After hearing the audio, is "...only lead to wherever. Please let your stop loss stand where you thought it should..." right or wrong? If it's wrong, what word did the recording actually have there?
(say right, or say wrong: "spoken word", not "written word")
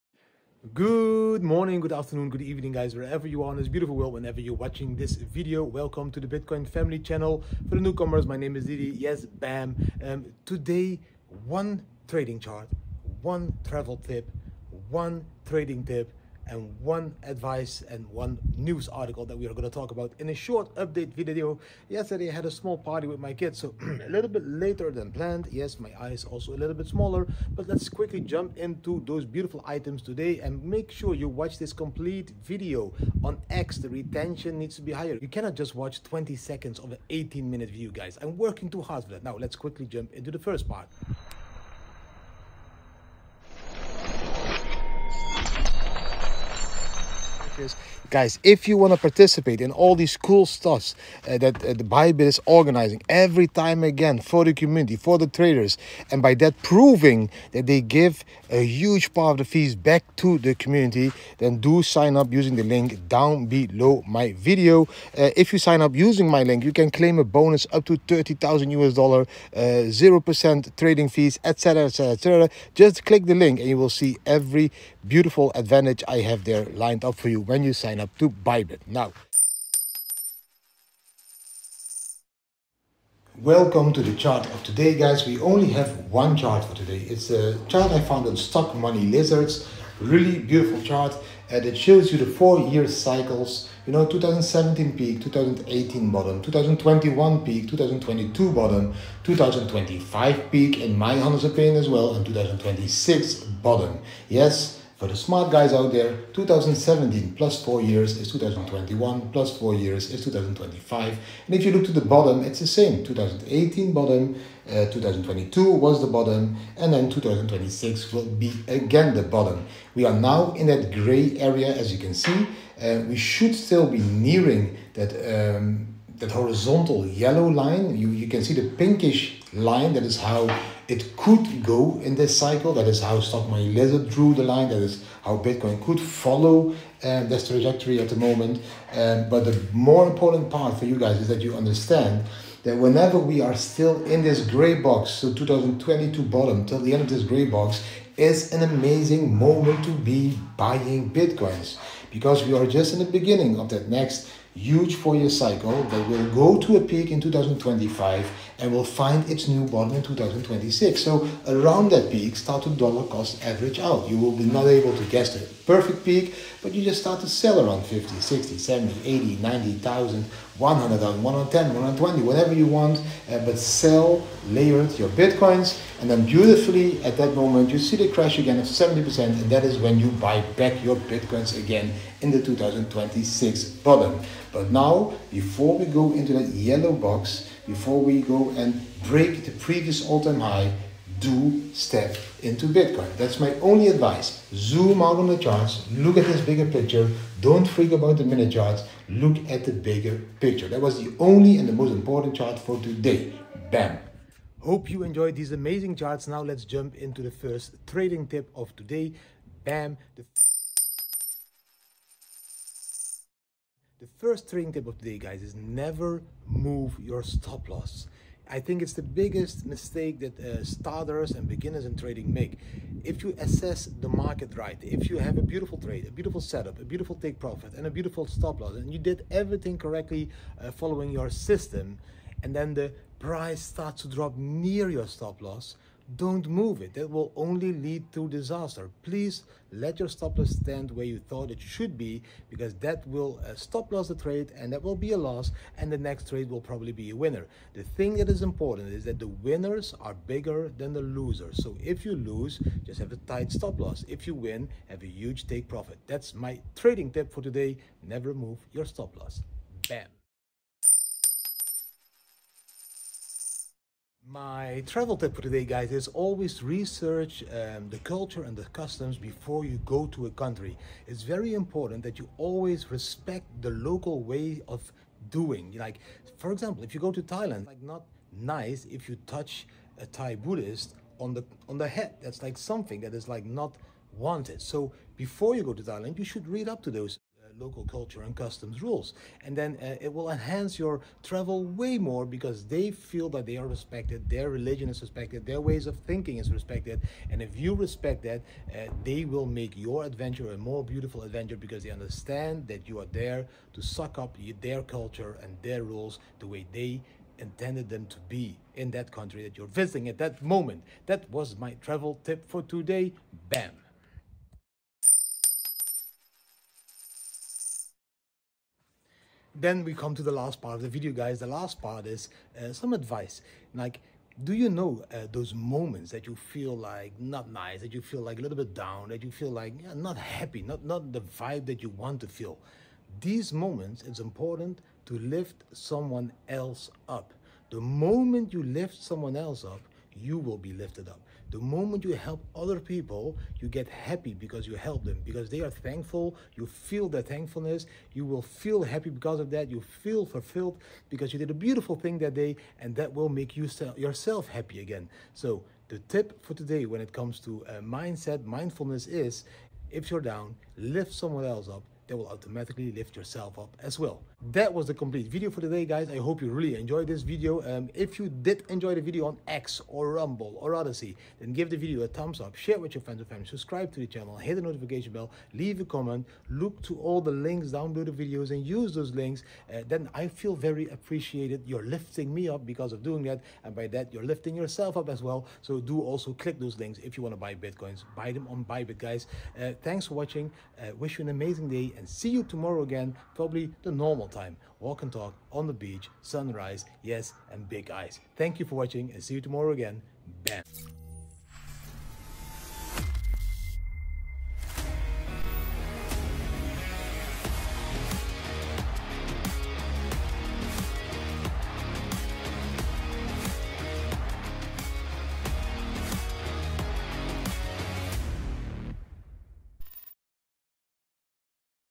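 wrong: "disaster", not "wherever".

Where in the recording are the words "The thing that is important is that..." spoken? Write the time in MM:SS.
04:07.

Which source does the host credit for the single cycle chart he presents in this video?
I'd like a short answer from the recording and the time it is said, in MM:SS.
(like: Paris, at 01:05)
Stockmoney Lizards, at 01:28.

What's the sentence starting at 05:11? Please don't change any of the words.
That was my travel tip for today.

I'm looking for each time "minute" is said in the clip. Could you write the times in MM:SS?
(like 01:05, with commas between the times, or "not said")
00:37, 03:18.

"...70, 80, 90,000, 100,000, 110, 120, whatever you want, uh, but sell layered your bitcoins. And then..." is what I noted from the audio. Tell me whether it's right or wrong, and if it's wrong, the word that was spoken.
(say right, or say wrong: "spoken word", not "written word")
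right.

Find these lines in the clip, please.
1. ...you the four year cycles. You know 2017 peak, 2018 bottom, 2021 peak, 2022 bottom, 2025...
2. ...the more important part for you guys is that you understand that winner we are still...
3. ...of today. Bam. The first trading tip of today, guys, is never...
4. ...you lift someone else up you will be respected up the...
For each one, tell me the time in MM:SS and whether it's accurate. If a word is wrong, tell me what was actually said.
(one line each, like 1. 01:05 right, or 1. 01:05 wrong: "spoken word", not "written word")
1. 01:32 right
2. 02:19 wrong: "whenever", not "winner"
3. 03:28 right
4. 05:38 wrong: "lifted", not "respected".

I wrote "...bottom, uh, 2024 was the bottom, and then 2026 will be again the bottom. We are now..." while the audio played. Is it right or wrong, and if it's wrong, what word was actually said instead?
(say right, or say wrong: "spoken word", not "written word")
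wrong: "2022", not "2024".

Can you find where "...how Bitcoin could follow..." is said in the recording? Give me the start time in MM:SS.
02:15.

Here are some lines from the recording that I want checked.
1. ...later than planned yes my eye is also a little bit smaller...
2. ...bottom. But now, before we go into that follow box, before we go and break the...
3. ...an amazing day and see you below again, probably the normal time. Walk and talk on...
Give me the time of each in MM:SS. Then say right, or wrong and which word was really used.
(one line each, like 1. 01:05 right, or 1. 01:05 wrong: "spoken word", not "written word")
1. 00:24 right
2. 03:03 wrong: "yellow", not "follow"
3. 06:31 wrong: "tomorrow", not "below".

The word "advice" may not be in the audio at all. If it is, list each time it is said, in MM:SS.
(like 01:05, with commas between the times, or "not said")
00:17, 03:13, 05:22.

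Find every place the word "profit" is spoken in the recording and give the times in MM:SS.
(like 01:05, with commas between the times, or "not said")
03:47, 04:15.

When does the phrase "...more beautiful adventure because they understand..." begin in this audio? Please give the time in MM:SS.
05:00.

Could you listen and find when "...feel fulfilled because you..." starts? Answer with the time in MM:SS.
05:49.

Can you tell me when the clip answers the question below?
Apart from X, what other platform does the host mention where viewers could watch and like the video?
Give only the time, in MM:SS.
06:10.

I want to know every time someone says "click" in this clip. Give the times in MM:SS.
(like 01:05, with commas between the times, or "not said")
01:13, 06:26.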